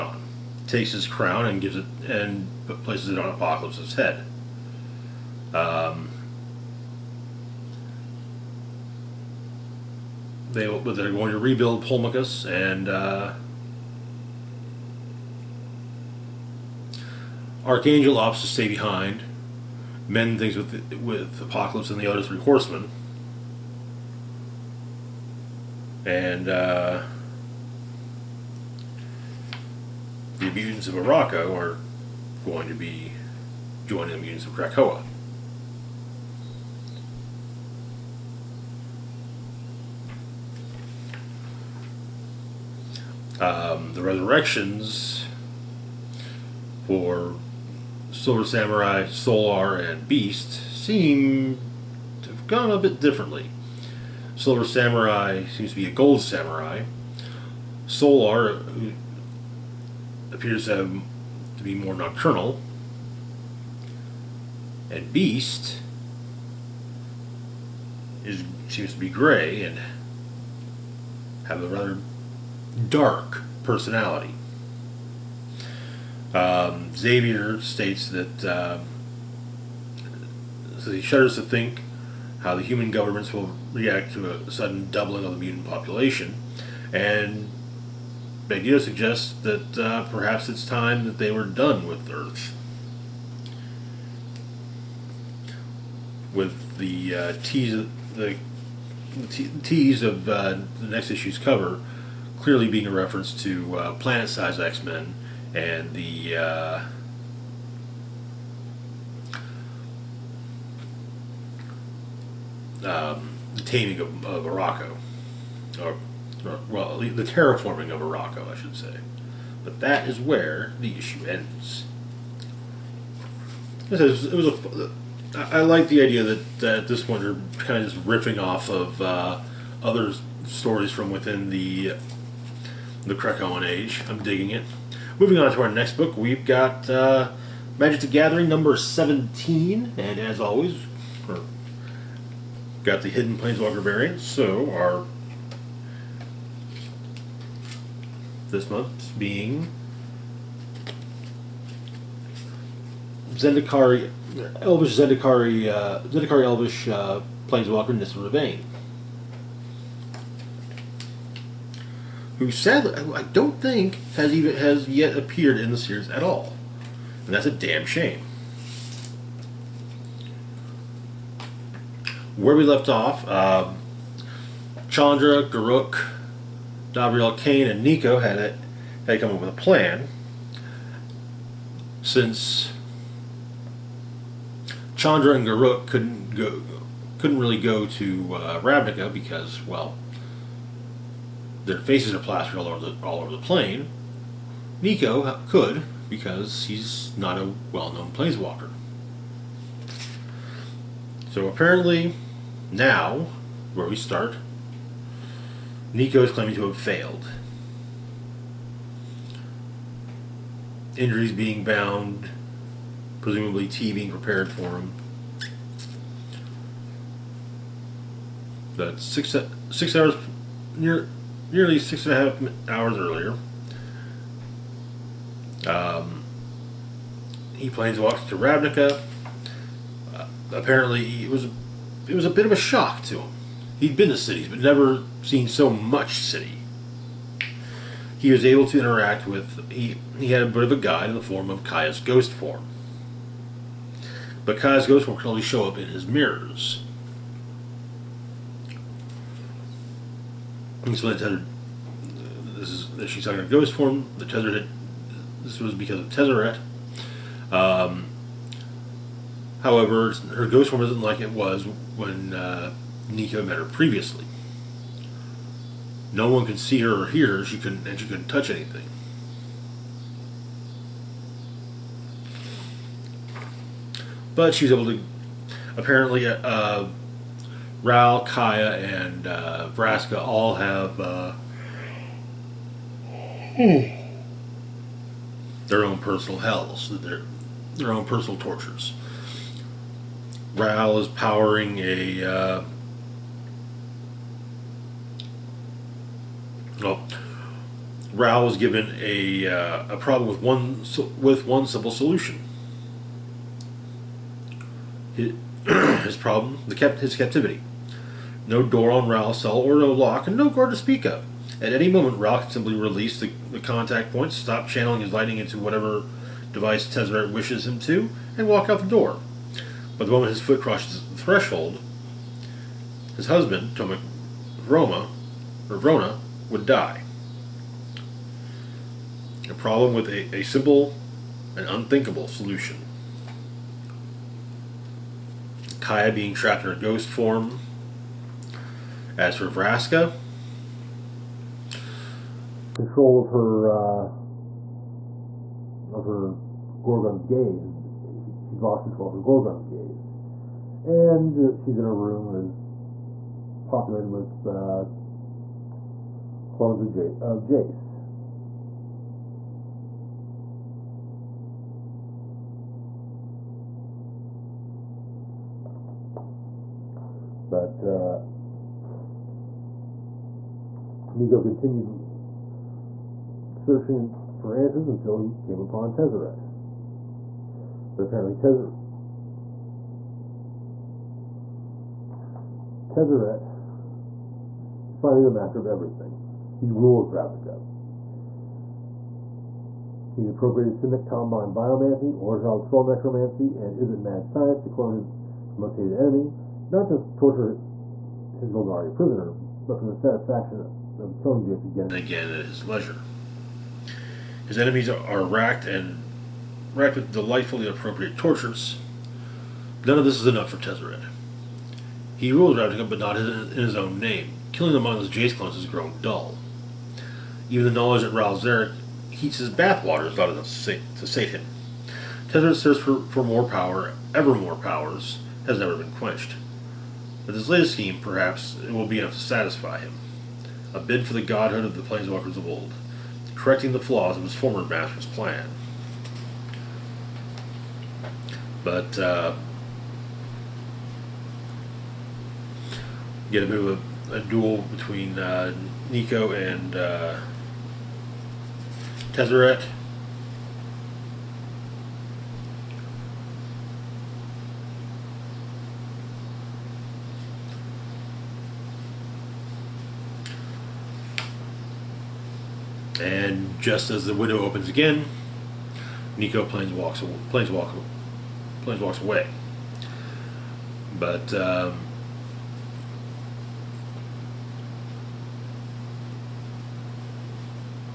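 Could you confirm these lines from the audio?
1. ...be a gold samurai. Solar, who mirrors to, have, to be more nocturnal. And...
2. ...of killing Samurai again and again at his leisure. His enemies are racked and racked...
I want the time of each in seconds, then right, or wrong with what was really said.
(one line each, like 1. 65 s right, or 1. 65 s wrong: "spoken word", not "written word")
1. 55 s wrong: "appears", not "mirrors"
2. 401 s wrong: "Jace", not "Samurai".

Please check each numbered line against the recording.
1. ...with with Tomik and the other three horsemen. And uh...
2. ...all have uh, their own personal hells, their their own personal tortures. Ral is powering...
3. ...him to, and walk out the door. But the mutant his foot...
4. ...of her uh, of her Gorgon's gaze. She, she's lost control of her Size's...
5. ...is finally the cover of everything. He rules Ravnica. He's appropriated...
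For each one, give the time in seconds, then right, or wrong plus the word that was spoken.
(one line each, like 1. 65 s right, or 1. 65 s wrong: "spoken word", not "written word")
1. 20 s wrong: "Apocalypse", not "Tomik"
2. 280 s right
3. 317 s wrong: "moment", not "mutant"
4. 343 s wrong: "Gorgon", not "Size"
5. 384 s wrong: "master", not "cover".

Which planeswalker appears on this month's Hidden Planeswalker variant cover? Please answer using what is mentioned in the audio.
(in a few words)
Nissa Revane.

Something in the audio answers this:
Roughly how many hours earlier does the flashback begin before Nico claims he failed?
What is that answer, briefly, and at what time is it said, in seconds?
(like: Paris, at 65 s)
6 and a half hours, at 221 s.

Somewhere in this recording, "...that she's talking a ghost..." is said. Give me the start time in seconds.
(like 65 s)
252 s.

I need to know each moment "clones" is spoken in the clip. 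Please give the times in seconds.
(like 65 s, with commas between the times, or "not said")
356 s, 394 s, 415 s.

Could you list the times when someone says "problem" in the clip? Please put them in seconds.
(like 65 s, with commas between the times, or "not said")
299 s, 306 s, 329 s.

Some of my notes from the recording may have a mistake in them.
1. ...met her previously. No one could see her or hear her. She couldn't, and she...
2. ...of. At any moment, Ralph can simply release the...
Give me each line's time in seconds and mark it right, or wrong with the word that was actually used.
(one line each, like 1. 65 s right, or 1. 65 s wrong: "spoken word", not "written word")
1. 263 s right
2. 311 s right.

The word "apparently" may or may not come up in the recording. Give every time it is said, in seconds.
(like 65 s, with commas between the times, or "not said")
201 s, 230 s, 275 s, 378 s.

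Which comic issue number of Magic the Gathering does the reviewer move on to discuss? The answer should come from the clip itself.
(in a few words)
17.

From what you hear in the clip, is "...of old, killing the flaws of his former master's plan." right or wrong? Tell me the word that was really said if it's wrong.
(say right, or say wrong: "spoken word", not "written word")
wrong: "correcting", not "killing".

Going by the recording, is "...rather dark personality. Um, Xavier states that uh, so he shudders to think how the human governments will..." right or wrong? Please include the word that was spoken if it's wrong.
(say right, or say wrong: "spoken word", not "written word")
right.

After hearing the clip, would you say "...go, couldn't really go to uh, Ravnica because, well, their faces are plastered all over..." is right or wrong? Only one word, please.
right.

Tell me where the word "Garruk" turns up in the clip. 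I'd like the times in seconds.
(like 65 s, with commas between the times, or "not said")
175 s, 185 s.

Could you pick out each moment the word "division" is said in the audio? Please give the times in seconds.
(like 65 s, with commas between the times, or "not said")
not said.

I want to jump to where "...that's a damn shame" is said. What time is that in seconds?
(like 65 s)
167 s.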